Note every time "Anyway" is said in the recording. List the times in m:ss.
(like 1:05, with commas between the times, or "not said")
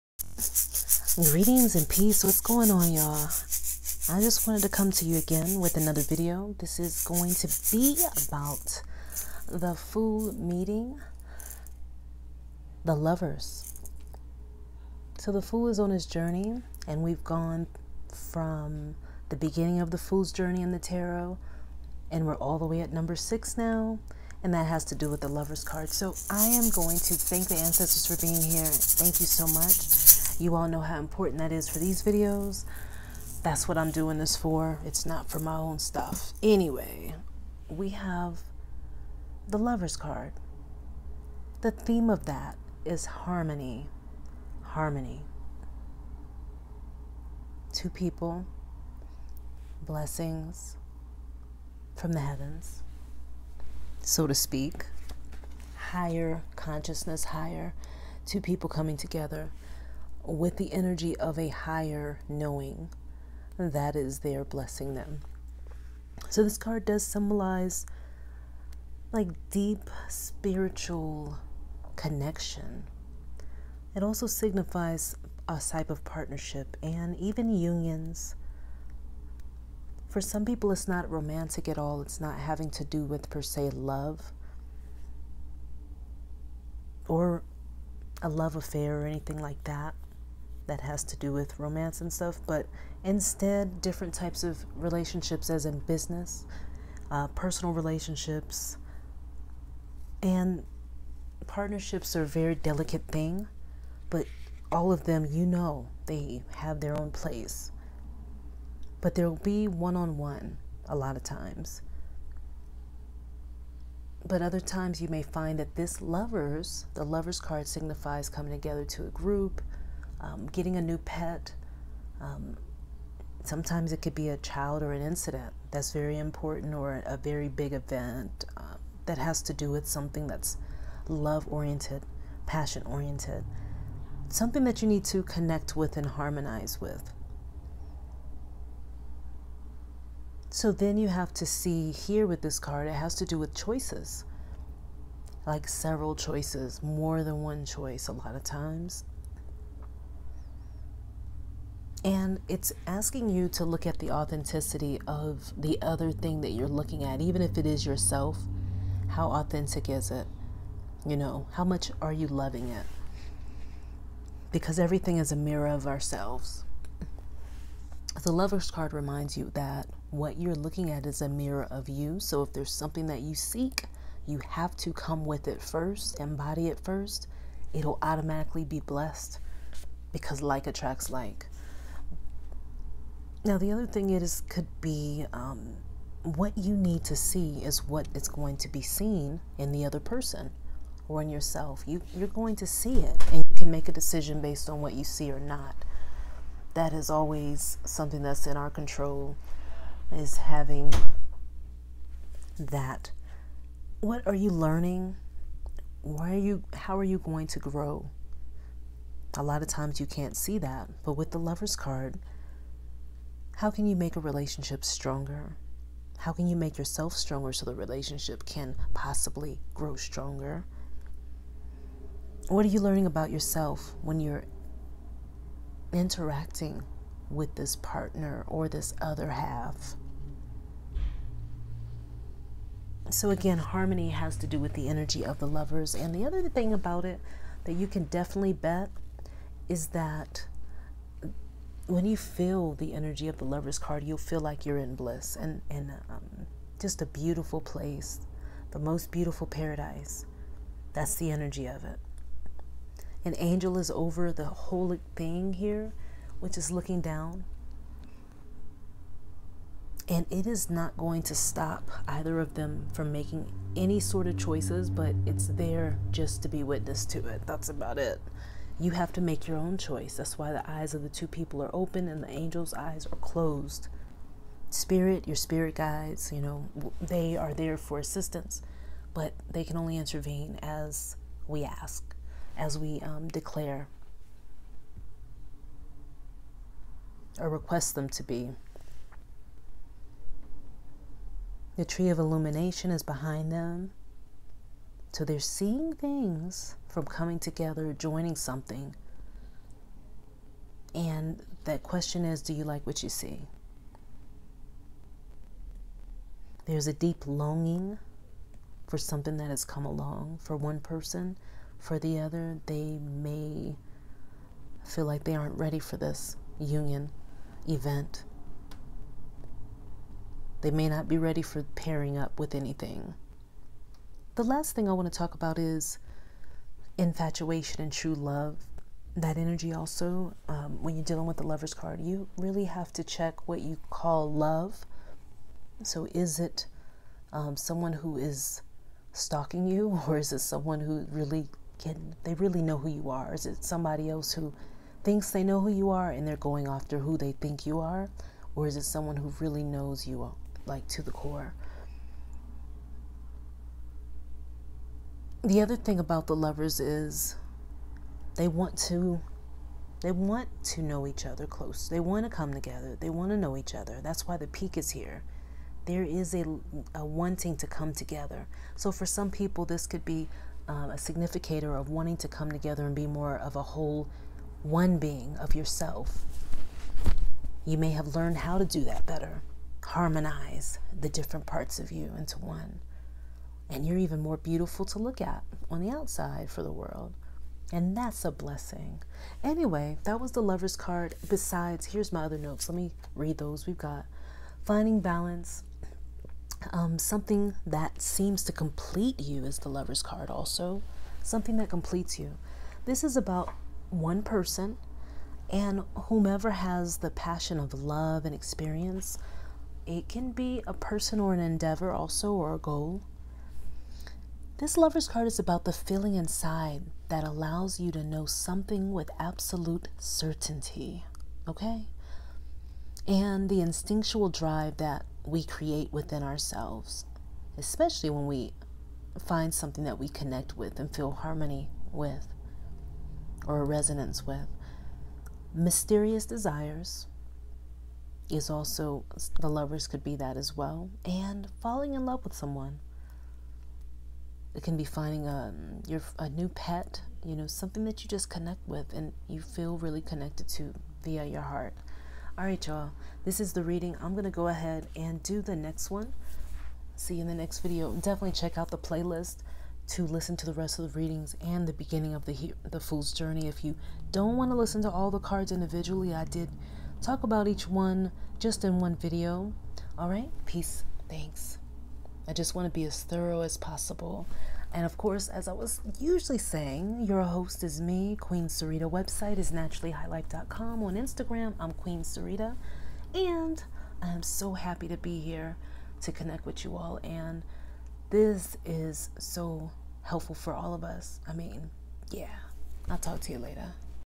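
0:36, 6:29.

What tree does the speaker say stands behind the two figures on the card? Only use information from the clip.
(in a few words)
Tree of illumination.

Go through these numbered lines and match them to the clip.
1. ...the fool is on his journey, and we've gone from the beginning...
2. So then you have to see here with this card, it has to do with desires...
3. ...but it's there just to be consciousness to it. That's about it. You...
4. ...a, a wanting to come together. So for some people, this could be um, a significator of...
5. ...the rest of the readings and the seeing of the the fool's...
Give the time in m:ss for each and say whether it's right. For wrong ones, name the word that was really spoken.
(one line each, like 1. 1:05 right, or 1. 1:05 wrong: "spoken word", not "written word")
1. 0:15 right
2. 2:20 wrong: "choices", not "desires"
3. 4:24 wrong: "witness", not "consciousness"
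4. 6:06 right
5. 7:40 wrong: "beginning", not "seeing".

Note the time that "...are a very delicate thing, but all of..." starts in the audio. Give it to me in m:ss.
1:42.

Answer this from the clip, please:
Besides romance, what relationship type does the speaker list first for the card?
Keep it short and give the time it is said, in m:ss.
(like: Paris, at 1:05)
Business, at 1:35.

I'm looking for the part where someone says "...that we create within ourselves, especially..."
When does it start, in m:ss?
7:04.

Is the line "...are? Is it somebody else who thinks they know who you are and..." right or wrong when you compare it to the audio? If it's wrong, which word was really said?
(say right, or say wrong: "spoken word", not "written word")
right.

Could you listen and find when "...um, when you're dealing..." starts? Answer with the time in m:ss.
5:30.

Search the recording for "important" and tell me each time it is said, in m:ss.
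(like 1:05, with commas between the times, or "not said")
0:30, 2:06.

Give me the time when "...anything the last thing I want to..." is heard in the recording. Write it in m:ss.
5:22.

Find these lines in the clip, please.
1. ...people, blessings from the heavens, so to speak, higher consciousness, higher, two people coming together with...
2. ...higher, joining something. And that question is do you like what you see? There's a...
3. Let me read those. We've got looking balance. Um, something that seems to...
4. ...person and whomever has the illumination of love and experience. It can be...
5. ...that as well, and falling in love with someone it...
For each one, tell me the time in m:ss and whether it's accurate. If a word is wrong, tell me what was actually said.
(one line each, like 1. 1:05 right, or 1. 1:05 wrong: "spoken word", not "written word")
1. 0:47 right
2. 4:57 wrong: "together", not "higher"
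3. 6:32 wrong: "finding", not "looking"
4. 6:44 wrong: "passion", not "illumination"
5. 7:20 right.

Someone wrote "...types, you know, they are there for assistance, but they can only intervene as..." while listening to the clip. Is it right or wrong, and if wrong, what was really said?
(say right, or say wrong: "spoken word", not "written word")
wrong: "guides", not "types".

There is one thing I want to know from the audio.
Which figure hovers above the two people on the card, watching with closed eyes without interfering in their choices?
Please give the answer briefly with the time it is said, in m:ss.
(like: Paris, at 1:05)
An angel, at 4:13.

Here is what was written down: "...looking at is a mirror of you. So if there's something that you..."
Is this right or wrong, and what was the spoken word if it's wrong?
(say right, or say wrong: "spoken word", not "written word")
right.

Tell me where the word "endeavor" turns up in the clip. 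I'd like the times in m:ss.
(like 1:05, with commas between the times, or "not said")
6:51.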